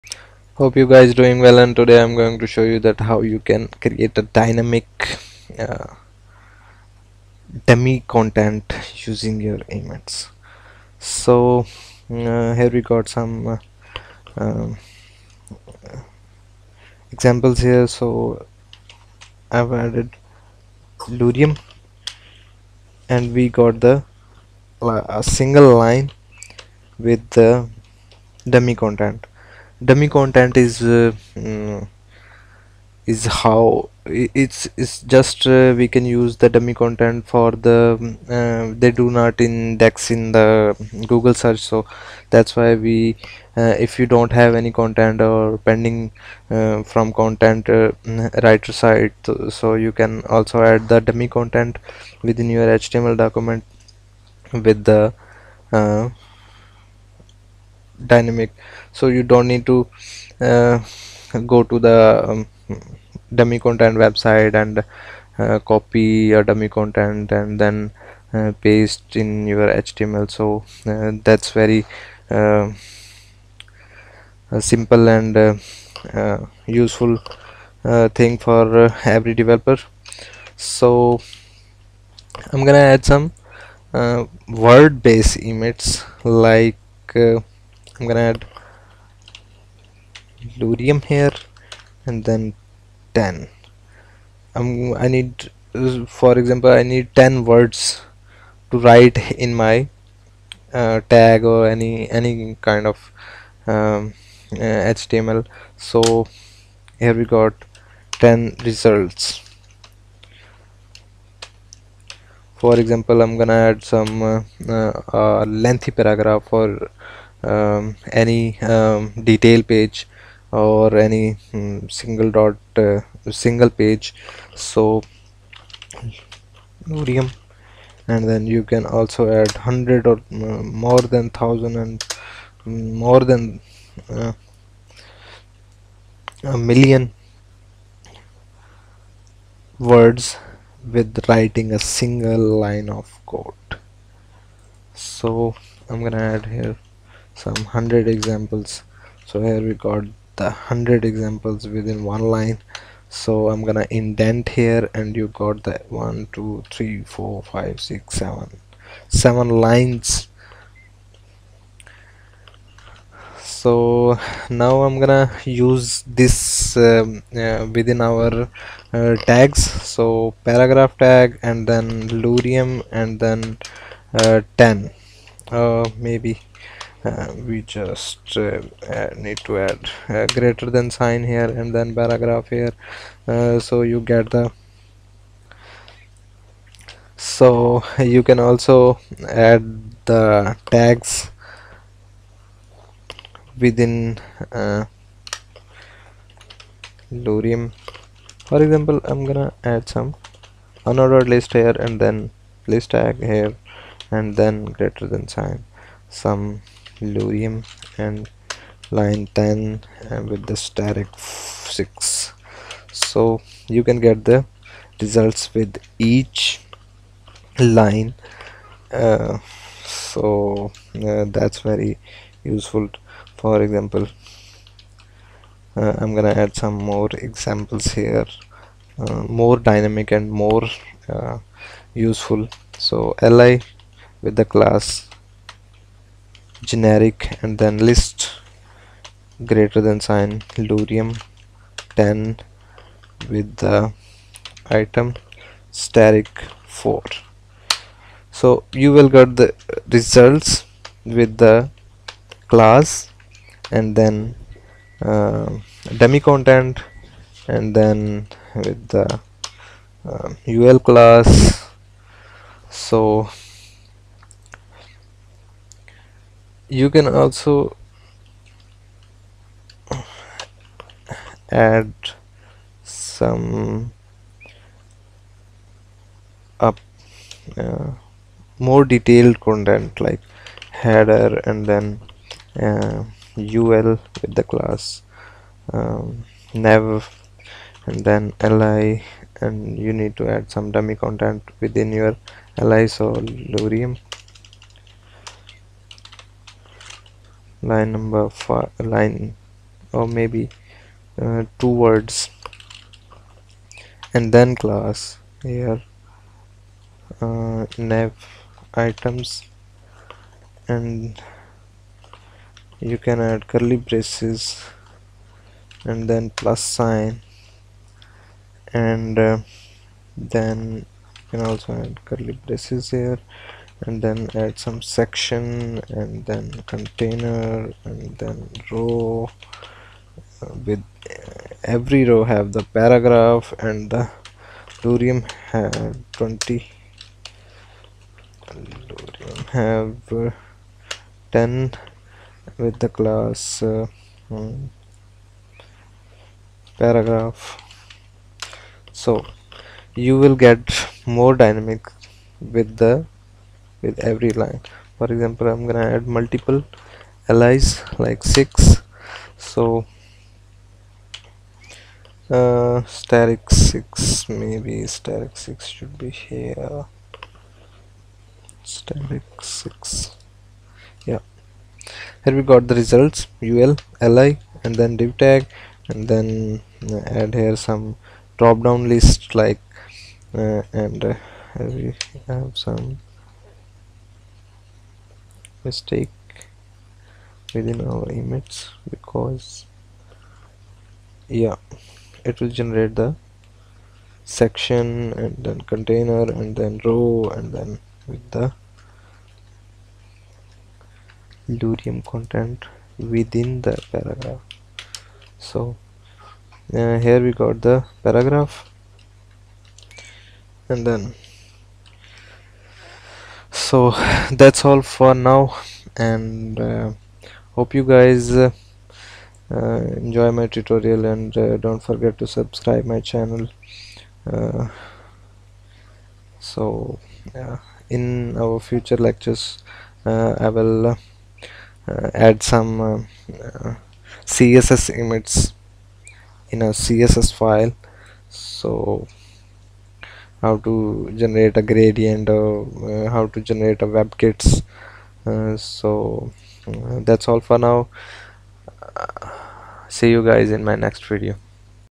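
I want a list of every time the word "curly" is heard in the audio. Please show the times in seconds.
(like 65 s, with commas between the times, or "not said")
313 s, 322 s.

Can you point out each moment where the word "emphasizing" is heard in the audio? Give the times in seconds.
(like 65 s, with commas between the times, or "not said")
not said.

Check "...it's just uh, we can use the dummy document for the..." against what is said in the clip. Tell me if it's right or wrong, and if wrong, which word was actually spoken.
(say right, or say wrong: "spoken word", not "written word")
wrong: "content", not "document".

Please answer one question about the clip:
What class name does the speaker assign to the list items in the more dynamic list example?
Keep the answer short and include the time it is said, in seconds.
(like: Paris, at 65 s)
generic, at 236 s.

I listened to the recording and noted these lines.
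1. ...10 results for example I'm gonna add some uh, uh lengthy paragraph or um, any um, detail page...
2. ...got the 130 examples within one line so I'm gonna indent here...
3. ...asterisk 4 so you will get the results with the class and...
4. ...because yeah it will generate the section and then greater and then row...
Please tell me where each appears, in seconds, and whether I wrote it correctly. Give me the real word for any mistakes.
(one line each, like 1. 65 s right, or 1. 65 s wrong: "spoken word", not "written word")
1. 108 s right
2. 149 s wrong: "100", not "130"
3. 245 s right
4. 388 s wrong: "container", not "greater".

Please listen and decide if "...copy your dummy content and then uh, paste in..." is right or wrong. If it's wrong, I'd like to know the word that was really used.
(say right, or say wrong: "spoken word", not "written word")
right.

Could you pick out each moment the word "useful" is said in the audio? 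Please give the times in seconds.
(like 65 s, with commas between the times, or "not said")
76 s, 222 s, 231 s.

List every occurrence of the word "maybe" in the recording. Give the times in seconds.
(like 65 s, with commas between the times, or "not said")
175 s, 300 s, 364 s.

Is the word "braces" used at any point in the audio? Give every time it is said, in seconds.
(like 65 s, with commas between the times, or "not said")
313 s, 322 s.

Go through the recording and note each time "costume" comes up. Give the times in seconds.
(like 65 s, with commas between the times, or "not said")
not said.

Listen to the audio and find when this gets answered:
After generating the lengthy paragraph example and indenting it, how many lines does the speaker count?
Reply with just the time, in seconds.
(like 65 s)
159 s.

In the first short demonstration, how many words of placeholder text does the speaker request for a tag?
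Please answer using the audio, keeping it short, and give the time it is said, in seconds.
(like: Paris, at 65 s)
10, at 97 s.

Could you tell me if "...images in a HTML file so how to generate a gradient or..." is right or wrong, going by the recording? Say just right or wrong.
wrong.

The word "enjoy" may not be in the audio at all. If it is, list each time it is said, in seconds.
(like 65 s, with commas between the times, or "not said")
419 s.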